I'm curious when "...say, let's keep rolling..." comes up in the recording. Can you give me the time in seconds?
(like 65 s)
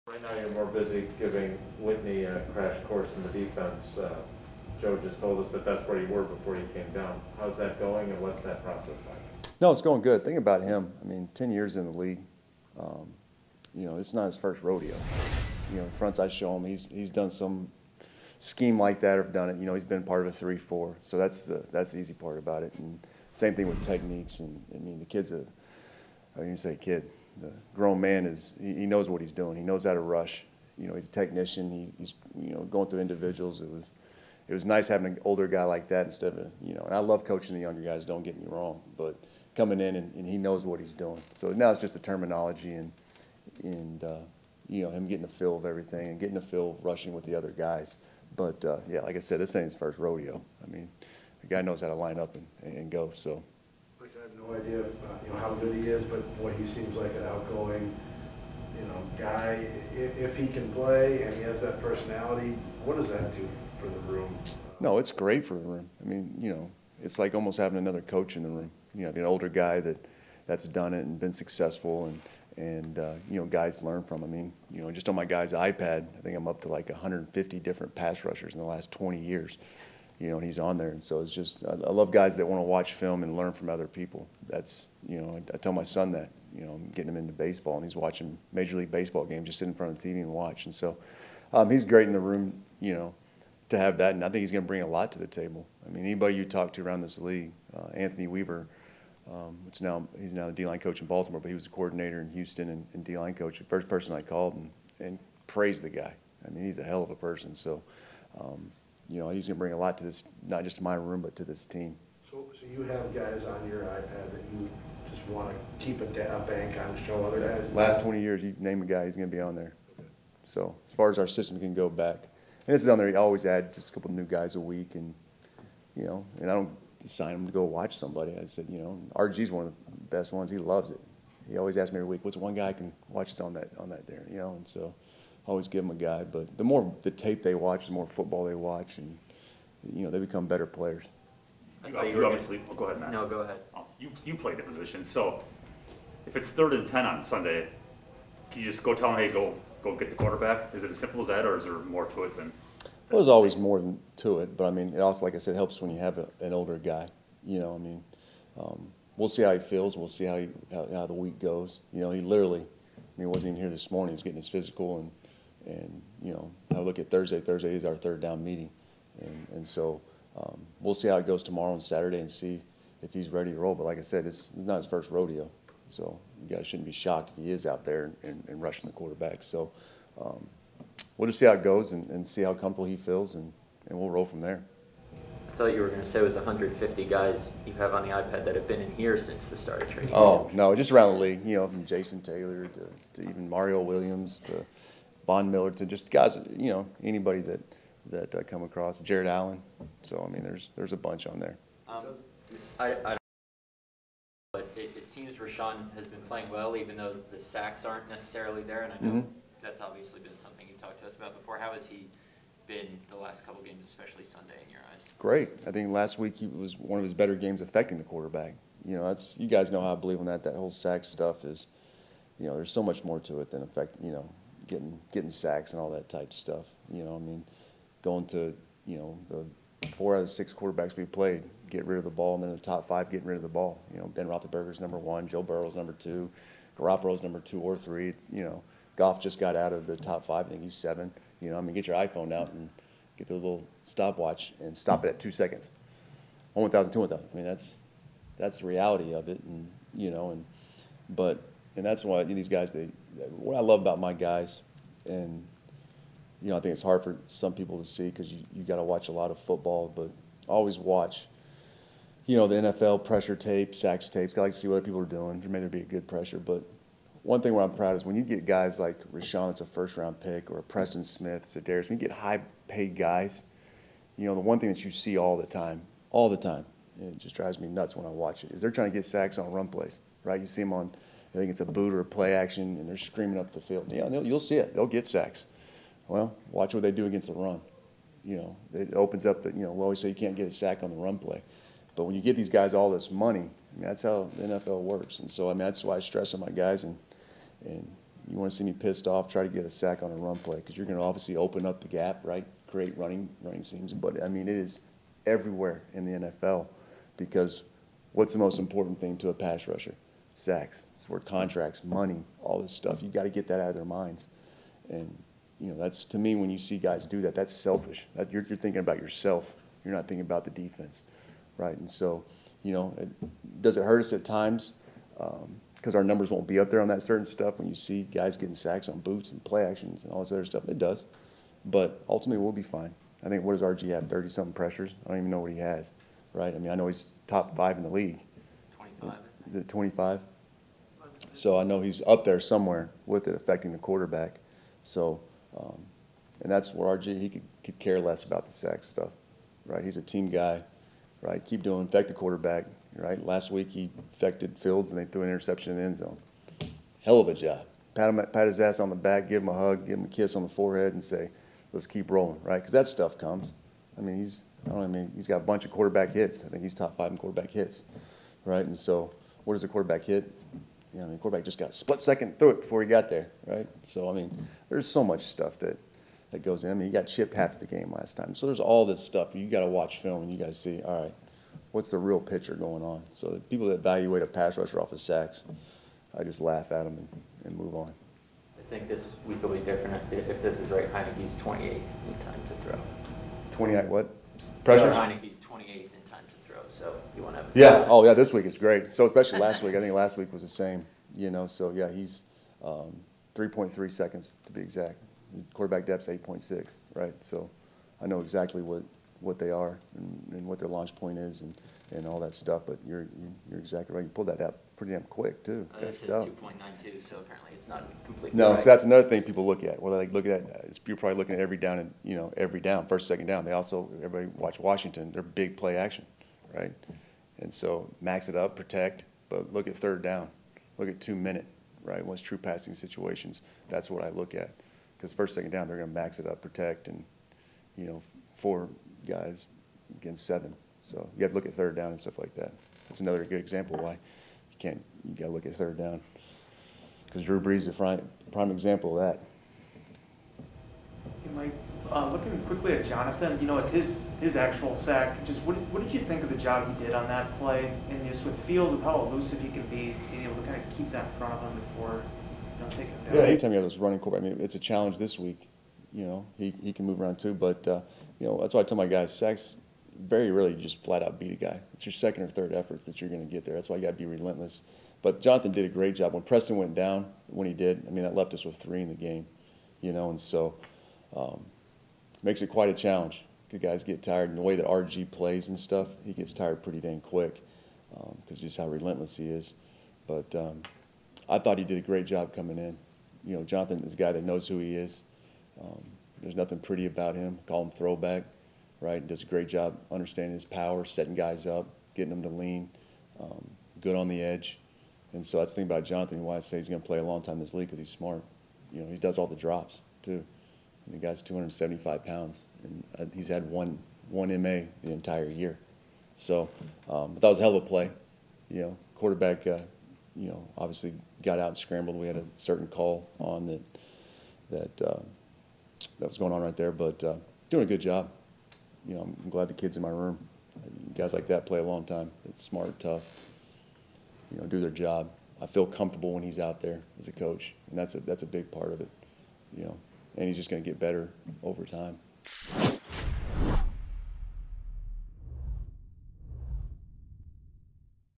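361 s.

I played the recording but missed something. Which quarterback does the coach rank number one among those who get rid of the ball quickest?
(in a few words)
Ben Roethlisberger.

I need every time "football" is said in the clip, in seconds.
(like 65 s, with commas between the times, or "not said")
138 s, 259 s.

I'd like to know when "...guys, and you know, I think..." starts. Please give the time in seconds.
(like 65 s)
254 s.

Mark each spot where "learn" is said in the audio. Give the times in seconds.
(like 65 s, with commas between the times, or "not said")
73 s, 83 s.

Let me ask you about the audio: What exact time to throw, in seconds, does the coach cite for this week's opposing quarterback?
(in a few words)
3.3 seconds.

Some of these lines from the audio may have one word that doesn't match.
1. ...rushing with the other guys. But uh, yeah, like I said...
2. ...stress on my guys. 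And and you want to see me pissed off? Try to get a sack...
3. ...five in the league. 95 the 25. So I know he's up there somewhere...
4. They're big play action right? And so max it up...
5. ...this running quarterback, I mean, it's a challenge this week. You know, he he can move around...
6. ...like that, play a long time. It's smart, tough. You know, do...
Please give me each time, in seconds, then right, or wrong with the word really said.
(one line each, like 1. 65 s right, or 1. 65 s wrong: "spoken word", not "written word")
1. 46 s right
2. 296 s right
3. 337 s wrong: "25", not "95"
4. 425 s right
5. 463 s right
6. 531 s right.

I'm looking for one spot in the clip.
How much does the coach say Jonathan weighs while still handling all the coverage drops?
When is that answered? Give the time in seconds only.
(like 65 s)
511 s.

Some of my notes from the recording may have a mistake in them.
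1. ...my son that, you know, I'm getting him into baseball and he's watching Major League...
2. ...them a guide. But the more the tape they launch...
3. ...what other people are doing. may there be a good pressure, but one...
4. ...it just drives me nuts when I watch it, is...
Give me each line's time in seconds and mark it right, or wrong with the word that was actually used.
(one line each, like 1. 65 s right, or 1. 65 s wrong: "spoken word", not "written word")
1. 85 s right
2. 135 s wrong: "watch", not "launch"
3. 264 s right
4. 276 s right.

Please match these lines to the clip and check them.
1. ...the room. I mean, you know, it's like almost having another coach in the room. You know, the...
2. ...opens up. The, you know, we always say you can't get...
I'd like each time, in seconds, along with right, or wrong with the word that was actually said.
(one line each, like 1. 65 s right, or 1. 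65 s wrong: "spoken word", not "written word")
1. 65 s right
2. 288 s right.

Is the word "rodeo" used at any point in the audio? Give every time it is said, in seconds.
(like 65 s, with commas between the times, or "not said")
14 s, 49 s, 175 s.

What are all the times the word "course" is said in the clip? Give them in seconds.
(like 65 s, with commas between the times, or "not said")
2 s.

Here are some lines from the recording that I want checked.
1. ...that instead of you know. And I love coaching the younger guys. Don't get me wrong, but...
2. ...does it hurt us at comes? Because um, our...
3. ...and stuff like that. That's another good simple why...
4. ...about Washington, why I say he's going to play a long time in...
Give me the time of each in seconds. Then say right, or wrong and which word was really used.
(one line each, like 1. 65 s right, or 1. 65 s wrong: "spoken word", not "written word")
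1. 35 s right
2. 323 s wrong: "times", not "comes"
3. 441 s wrong: "example", not "simple"
4. 505 s wrong: "Jonathan", not "Washington".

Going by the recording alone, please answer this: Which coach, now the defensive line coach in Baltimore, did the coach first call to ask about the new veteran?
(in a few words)
Anthony Weaver.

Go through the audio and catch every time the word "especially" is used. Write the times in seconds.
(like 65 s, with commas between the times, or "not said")
213 s, 399 s.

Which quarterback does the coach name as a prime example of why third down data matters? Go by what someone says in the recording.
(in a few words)
Drew Brees.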